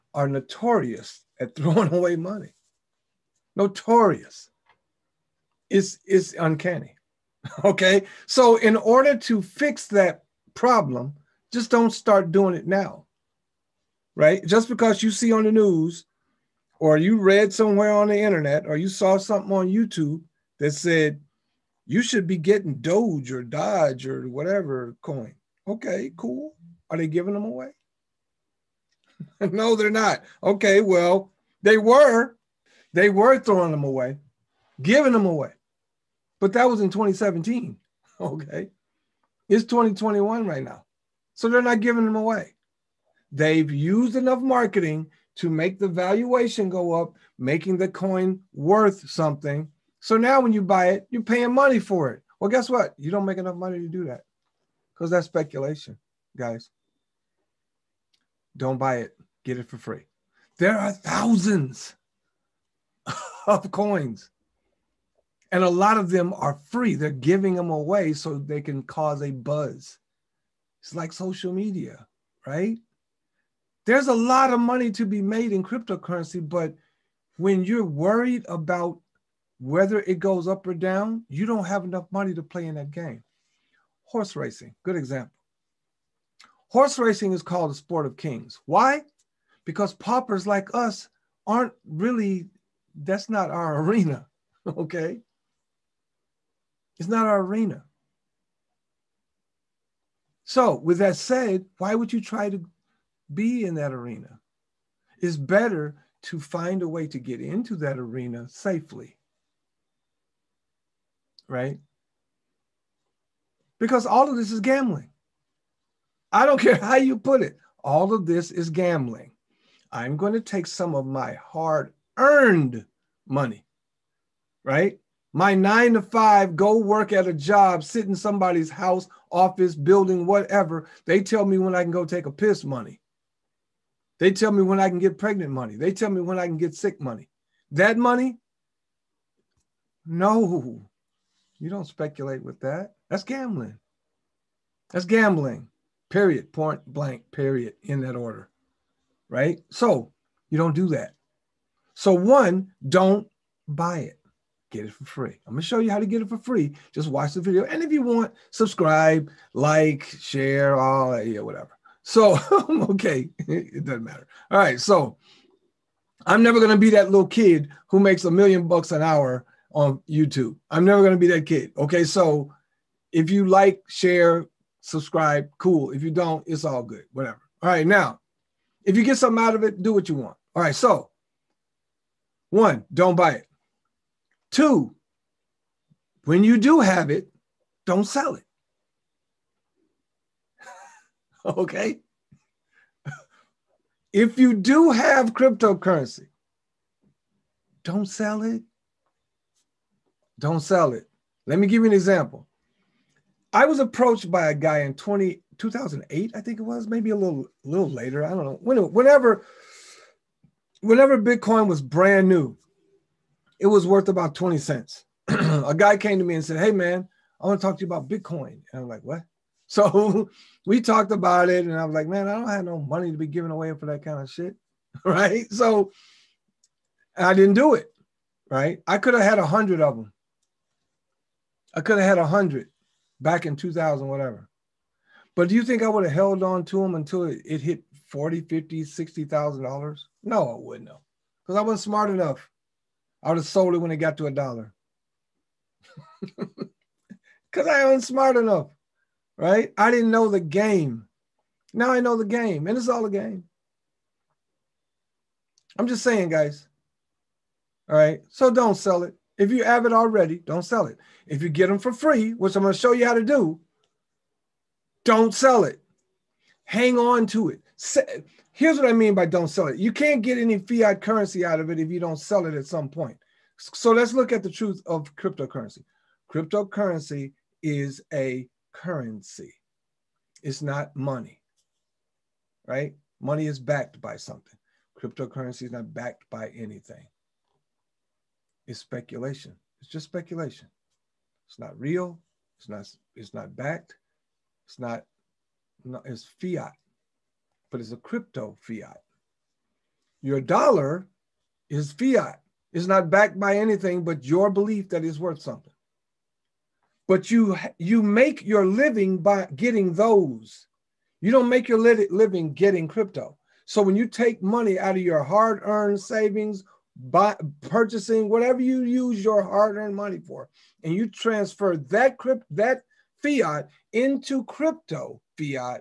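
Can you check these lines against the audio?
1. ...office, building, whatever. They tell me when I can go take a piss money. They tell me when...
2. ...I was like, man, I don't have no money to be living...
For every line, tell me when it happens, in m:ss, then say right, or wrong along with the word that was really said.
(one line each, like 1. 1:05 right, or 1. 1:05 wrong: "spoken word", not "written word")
1. 2:09 right
2. 3:41 wrong: "giving", not "living".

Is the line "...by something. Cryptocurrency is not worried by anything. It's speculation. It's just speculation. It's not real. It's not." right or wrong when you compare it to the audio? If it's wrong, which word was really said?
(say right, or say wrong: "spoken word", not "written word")
wrong: "backed", not "worried".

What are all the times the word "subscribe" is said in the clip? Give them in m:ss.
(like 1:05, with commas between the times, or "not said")
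2:38, 2:54.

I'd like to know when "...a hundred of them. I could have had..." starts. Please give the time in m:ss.
3:49.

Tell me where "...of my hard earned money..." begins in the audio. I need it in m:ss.
2:00.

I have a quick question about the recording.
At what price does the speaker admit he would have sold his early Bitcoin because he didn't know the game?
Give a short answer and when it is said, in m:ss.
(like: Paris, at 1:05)
a dollar, at 4:04.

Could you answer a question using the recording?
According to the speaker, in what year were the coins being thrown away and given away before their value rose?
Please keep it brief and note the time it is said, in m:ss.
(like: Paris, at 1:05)
2017, at 0:36.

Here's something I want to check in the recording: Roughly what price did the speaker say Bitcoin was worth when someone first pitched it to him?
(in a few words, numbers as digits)
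20 cents.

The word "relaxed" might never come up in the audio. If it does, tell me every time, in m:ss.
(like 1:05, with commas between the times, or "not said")
not said.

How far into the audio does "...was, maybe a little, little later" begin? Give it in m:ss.
3:26.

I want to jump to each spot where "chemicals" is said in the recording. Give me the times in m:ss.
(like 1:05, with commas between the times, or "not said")
not said.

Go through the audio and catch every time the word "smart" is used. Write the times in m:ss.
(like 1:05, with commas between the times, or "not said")
4:01, 4:08.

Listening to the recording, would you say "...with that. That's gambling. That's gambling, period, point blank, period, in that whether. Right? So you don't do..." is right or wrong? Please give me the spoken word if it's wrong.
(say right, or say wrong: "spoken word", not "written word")
wrong: "order", not "whether".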